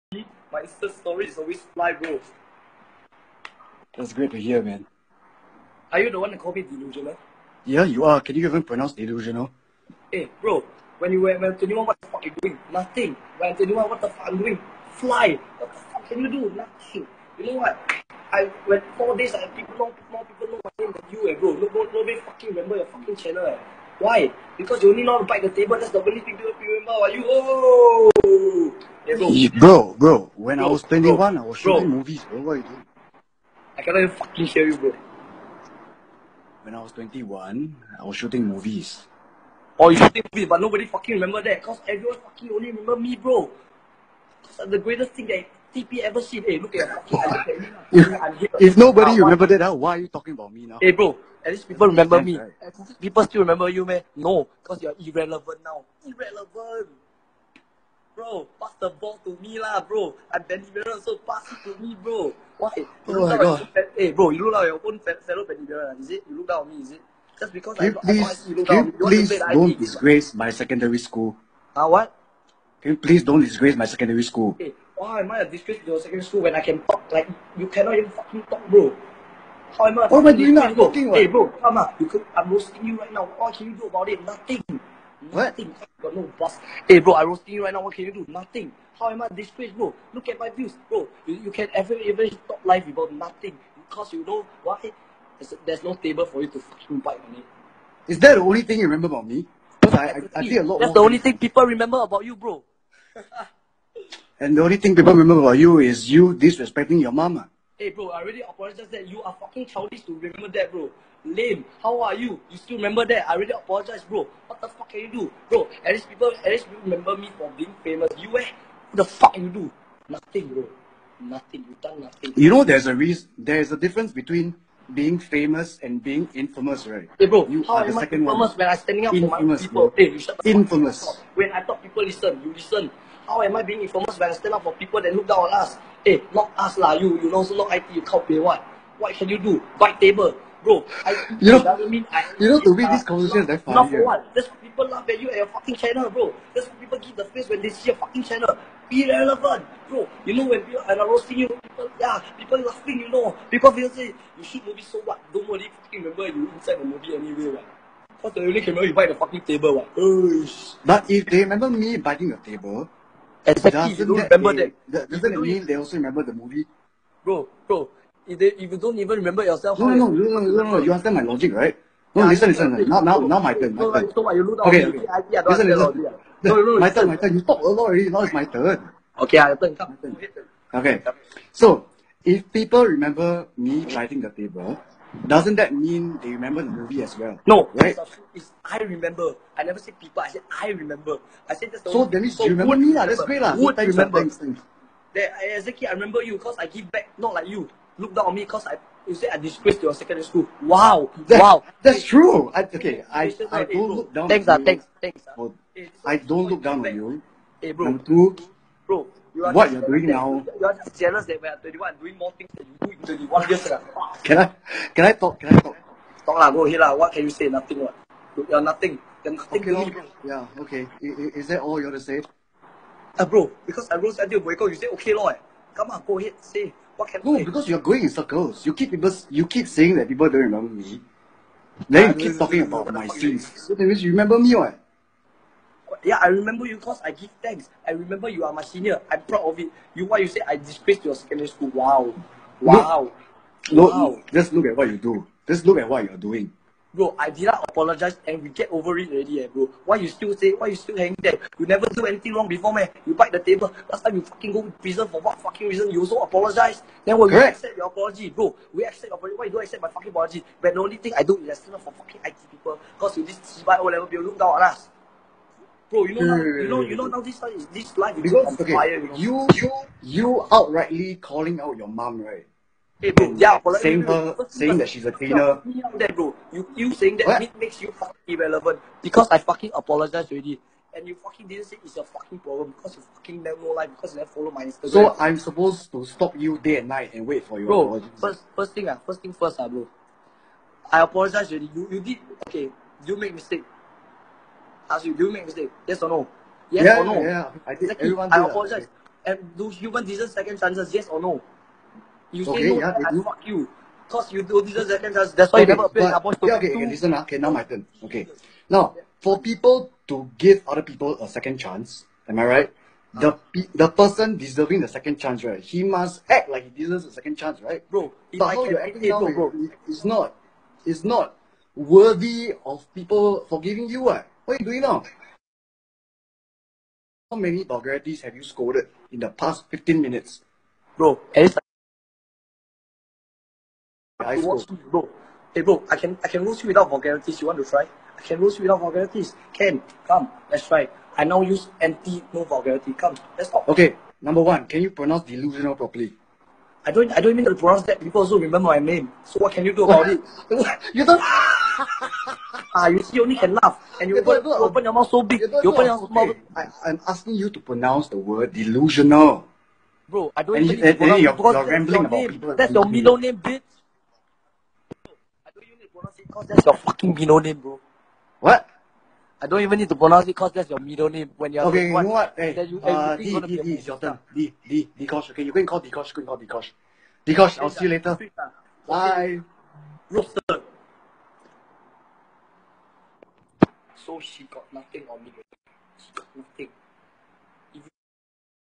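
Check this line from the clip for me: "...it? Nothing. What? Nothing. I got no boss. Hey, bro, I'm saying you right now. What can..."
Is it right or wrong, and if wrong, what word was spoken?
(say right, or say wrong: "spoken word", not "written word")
wrong: "roasting", not "saying".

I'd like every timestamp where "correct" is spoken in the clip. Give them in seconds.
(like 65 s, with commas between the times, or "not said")
257 s, 273 s.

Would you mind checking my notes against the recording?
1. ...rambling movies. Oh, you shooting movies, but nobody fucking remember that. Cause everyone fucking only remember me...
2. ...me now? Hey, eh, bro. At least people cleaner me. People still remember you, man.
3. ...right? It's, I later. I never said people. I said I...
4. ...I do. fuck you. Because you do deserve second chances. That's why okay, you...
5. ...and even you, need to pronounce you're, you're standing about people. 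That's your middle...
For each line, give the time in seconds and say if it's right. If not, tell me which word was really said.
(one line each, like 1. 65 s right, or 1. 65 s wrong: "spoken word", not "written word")
1. 38 s wrong: "shooting", not "rambling"
2. 50 s wrong: "remember", not "cleaner"
3. 187 s wrong: "remember", not "later"
4. 303 s right
5. 360 s wrong: "rambling", not "standing".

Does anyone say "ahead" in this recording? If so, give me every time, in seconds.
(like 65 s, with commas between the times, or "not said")
216 s, 226 s.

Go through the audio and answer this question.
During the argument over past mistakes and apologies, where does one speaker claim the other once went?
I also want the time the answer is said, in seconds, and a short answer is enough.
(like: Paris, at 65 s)
prison, at 254 s.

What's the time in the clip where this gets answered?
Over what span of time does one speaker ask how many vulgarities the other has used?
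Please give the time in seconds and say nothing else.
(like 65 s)
329 s.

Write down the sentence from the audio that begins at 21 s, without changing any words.
No, nobody fucking remember your fucking channel, eh.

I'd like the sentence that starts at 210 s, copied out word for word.
You are just jealous that we are 21 doing more things than you do in 21 years.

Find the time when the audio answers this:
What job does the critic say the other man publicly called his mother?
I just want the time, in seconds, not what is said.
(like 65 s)
275 s.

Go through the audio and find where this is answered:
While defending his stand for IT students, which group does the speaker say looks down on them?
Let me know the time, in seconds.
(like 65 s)
263 s.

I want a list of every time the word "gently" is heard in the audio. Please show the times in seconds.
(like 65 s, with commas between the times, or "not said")
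not said.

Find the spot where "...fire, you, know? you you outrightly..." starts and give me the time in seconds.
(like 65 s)
268 s.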